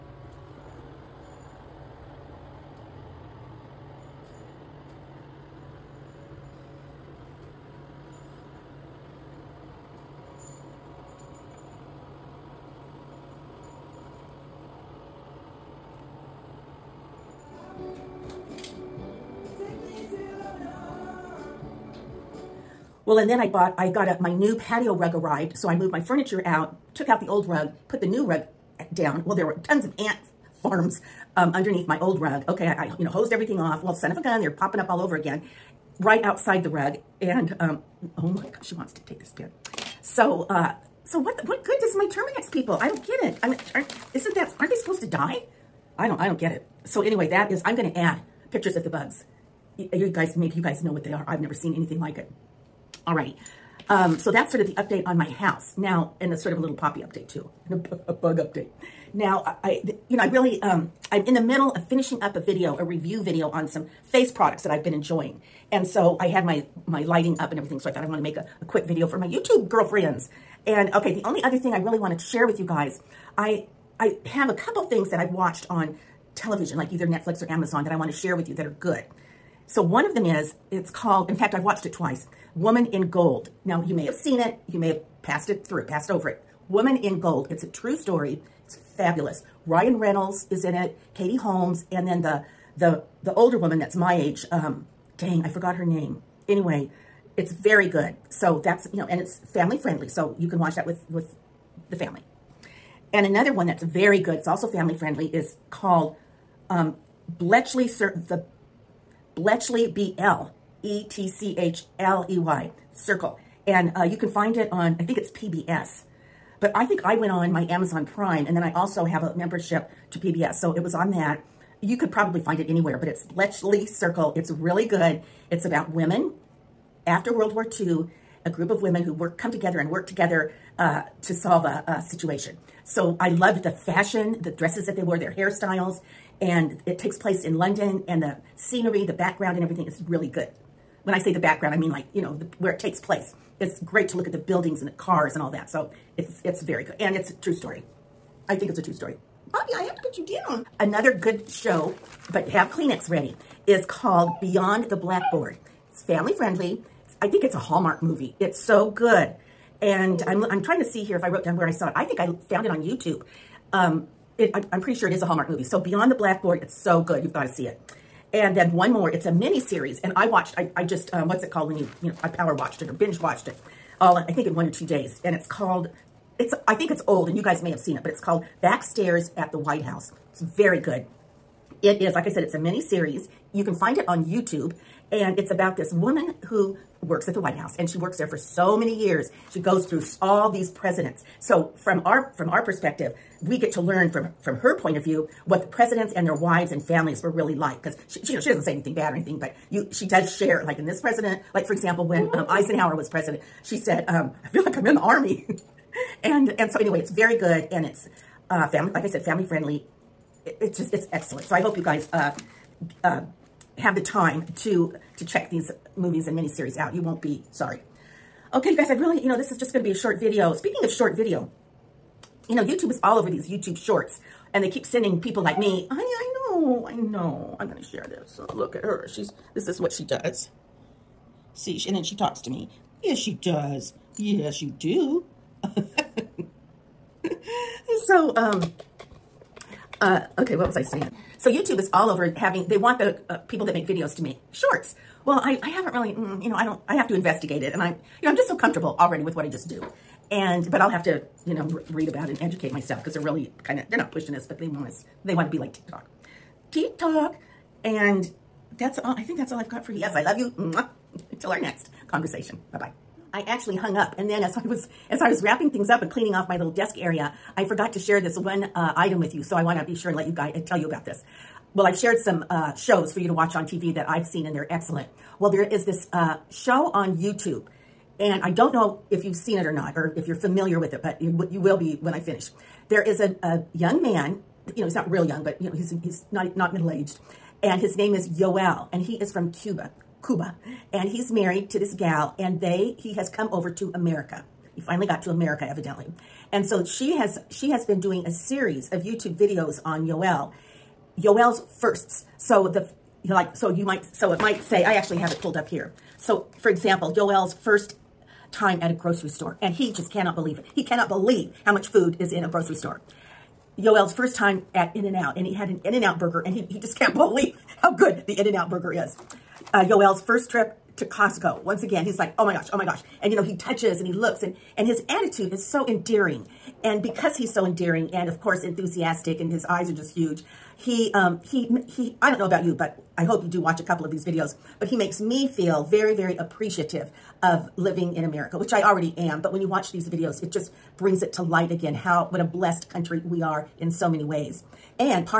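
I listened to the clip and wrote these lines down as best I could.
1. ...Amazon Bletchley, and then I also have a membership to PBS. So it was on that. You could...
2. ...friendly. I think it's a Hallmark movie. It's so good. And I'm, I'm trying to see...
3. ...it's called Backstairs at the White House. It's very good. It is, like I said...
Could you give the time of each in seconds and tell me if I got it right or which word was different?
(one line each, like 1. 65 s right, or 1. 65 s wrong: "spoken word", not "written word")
1. 117 s wrong: "Prime", not "Bletchley"
2. 156 s right
3. 178 s right.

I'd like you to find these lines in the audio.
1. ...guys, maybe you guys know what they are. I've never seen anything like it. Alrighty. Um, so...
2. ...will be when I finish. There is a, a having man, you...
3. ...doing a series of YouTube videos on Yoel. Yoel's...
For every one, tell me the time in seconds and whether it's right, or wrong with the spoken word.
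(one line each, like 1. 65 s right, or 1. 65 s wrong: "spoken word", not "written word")
1. 50 s right
2. 281 s wrong: "young", not "having"
3. 298 s right.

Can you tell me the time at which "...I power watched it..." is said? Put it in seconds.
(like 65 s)
172 s.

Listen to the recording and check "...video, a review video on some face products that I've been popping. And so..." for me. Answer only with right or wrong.
wrong.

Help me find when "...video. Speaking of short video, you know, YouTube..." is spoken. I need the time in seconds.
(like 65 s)
220 s.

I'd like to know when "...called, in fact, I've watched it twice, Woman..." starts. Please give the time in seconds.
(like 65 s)
80 s.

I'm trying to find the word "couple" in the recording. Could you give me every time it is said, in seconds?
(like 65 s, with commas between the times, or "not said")
74 s, 333 s.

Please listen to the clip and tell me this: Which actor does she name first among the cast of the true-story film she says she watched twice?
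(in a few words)
Ryan Reynolds.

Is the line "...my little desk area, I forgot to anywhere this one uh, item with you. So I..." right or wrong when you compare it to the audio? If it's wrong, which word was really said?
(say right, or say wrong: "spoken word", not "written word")
wrong: "share", not "anywhere".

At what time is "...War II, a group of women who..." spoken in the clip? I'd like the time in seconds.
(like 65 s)
127 s.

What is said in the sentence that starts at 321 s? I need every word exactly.
Once again, he's like, oh my gosh, oh my gosh.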